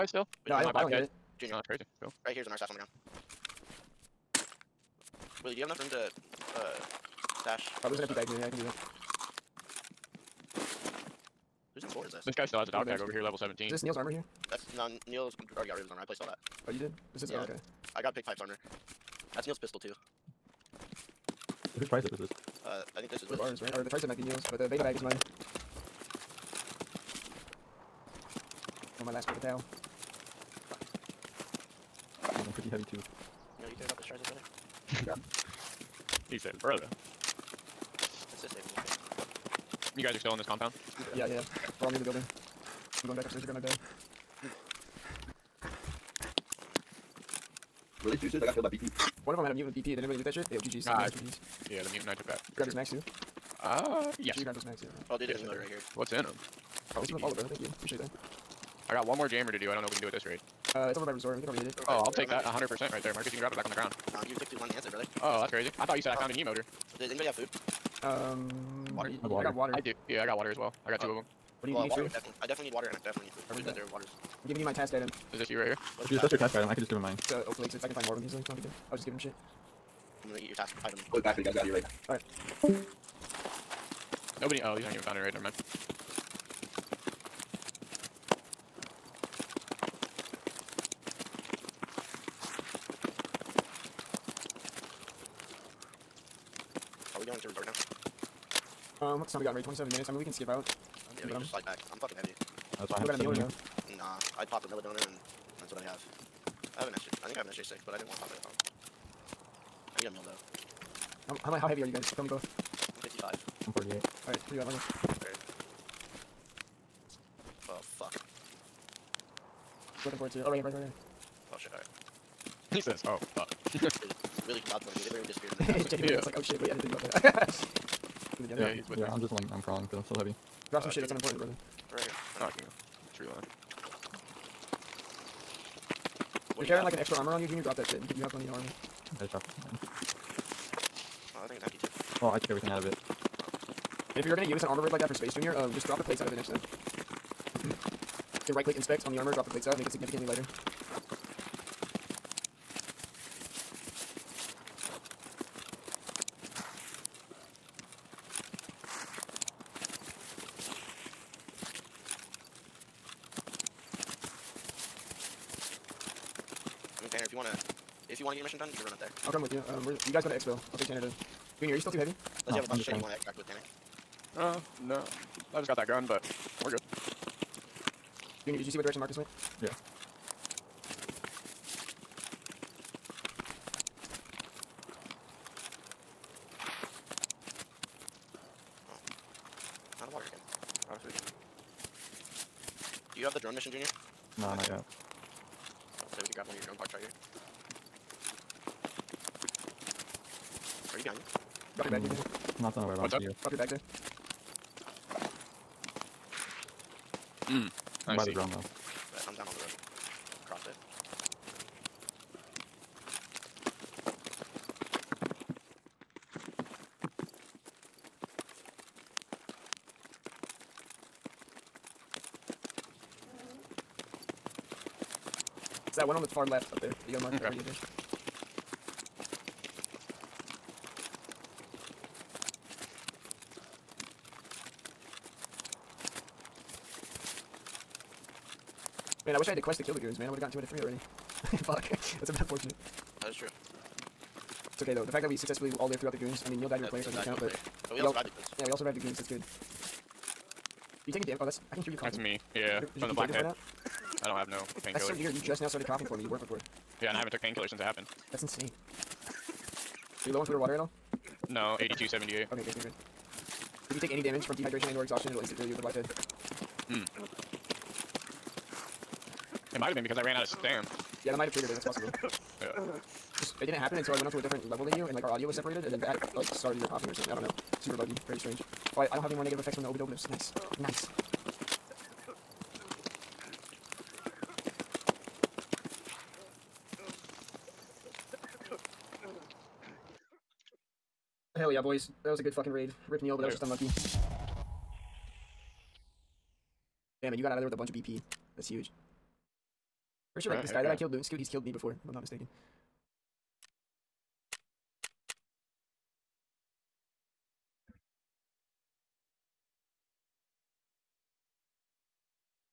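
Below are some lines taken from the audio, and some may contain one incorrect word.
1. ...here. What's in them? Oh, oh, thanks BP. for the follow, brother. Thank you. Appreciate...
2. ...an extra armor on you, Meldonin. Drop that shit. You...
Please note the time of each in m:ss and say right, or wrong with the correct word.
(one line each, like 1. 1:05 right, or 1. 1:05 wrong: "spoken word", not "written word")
1. 0:55 right
2. 2:16 wrong: "Junior", not "Meldonin".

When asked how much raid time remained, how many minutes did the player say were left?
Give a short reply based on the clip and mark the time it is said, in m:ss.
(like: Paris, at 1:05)
27 minutes, at 1:39.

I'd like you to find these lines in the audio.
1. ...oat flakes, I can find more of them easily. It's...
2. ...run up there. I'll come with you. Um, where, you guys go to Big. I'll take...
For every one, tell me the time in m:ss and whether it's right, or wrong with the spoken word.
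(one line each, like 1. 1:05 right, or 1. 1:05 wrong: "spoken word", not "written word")
1. 1:17 right
2. 2:48 wrong: "Expo", not "Big".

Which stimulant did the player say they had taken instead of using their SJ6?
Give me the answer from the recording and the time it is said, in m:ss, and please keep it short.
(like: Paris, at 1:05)
Meldonin, at 1:44.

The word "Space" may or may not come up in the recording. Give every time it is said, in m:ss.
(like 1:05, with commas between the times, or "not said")
2:25.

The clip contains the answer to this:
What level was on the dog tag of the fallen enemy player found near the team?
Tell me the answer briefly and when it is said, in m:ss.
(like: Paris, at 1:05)
17, at 0:13.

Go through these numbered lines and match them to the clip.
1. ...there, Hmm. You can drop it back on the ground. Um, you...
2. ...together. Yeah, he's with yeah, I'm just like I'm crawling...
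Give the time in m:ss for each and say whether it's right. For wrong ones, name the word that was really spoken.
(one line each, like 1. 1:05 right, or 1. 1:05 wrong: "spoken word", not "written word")
1. 1:03 wrong: "Marcus", not "Hmm"
2. 2:08 right.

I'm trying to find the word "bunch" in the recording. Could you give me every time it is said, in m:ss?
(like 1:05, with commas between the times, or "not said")
2:52, 4:57.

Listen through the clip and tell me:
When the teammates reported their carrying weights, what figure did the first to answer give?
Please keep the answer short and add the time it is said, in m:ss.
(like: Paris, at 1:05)
55, at 1:52.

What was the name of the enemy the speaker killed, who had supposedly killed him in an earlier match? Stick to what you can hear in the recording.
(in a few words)
Loon Scoot.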